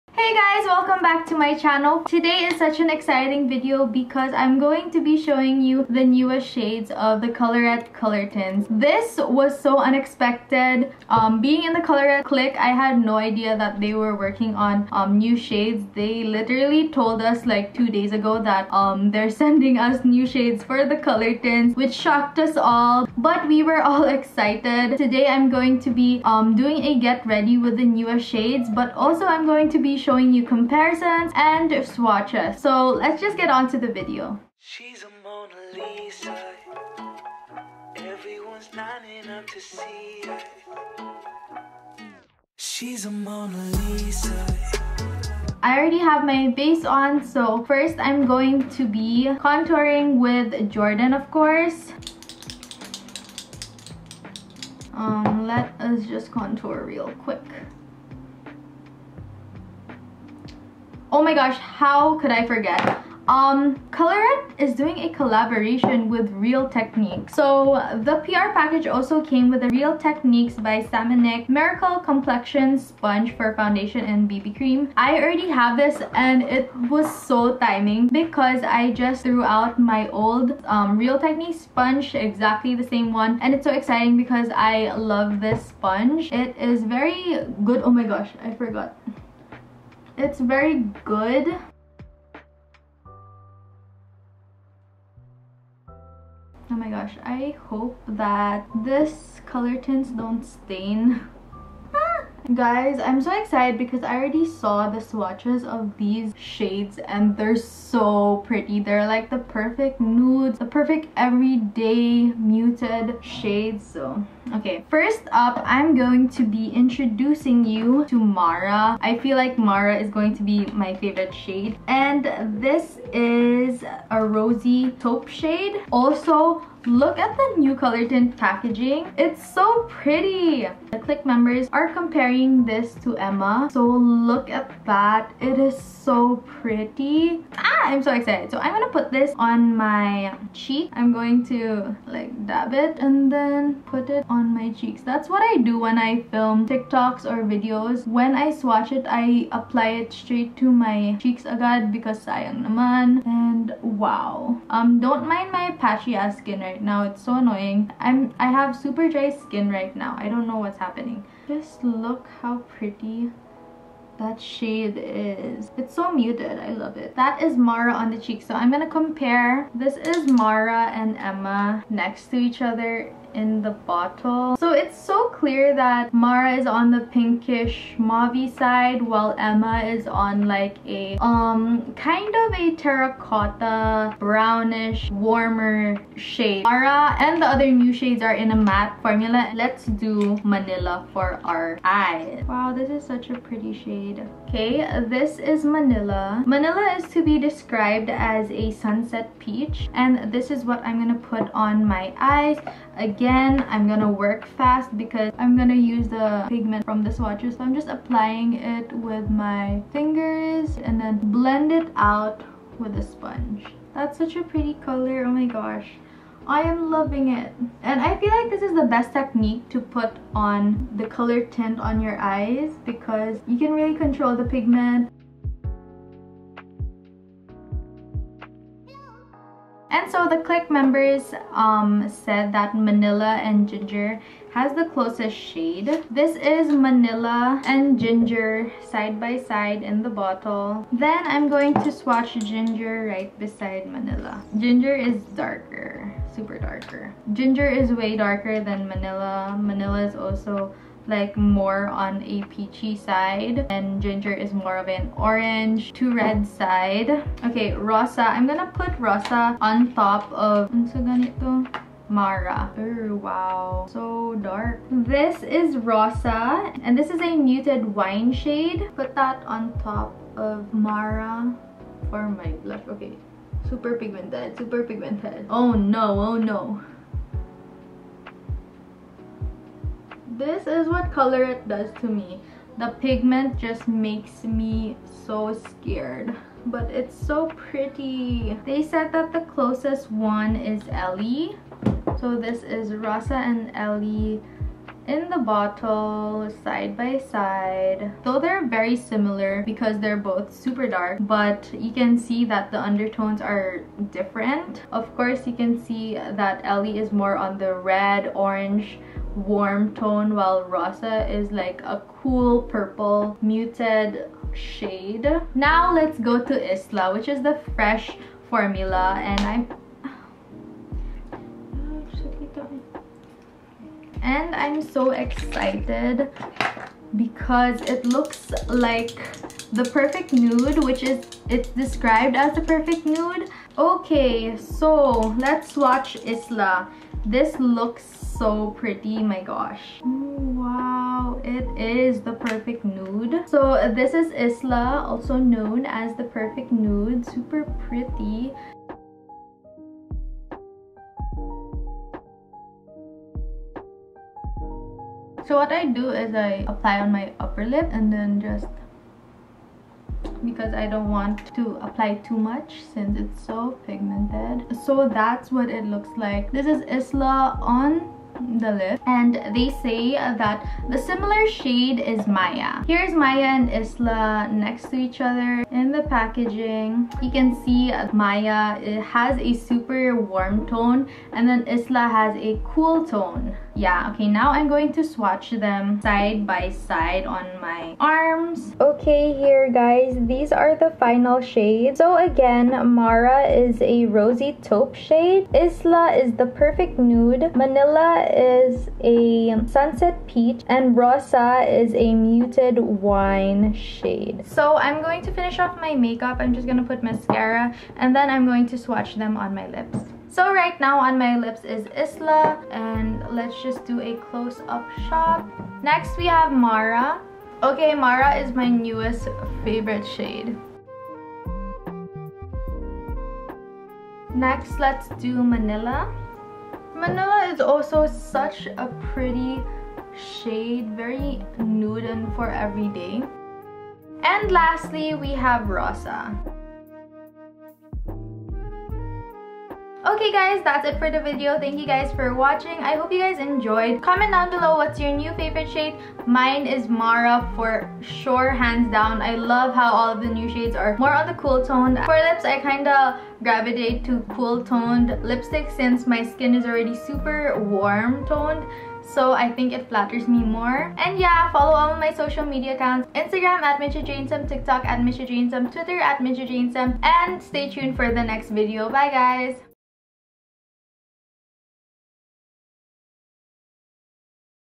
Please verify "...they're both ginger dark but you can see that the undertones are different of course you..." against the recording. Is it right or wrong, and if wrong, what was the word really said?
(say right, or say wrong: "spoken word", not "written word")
wrong: "super", not "ginger".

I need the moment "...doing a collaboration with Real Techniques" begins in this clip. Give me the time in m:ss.
1:04.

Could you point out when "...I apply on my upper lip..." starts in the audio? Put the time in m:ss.
5:56.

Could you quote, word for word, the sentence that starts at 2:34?
Um, don't mind my patchy ass skin right now.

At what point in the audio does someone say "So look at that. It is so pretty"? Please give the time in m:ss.
2:13.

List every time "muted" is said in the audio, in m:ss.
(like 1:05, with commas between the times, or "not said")
1:52, 2:46, 4:27, 5:13, 6:42.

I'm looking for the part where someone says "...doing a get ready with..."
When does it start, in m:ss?
0:26.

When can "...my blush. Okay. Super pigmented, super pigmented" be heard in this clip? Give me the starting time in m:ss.
4:32.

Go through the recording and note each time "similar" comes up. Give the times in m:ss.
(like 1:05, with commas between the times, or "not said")
4:58, 6:10.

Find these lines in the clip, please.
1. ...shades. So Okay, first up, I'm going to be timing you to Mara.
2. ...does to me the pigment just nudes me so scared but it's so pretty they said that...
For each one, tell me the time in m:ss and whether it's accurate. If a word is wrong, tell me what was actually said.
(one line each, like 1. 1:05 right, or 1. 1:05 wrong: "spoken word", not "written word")
1. 1:53 wrong: "introducing", not "timing"
2. 4:41 wrong: "makes", not "nudes".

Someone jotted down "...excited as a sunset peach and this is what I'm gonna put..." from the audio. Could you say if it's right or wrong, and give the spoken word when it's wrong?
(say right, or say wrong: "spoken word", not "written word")
wrong: "described", not "excited".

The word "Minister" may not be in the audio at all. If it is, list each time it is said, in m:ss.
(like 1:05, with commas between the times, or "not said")
not said.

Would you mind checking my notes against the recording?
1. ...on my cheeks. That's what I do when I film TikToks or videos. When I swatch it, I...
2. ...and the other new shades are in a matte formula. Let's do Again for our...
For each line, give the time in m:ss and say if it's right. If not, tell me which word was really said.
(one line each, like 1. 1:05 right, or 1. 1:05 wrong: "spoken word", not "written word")
1. 2:24 right
2. 3:07 wrong: "Manila", not "Again".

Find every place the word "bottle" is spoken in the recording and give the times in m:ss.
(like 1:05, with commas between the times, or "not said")
2:53, 4:00, 4:55.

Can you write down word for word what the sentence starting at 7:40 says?
And yeah, follow all my social media accounts.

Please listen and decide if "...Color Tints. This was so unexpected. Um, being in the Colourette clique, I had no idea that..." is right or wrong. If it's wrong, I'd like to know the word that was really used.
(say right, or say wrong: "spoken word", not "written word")
right.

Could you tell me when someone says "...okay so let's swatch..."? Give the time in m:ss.
5:33.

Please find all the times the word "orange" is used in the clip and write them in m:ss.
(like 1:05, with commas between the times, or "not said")
4:15, 5:08.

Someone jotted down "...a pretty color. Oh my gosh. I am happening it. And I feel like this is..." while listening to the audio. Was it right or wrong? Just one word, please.
wrong.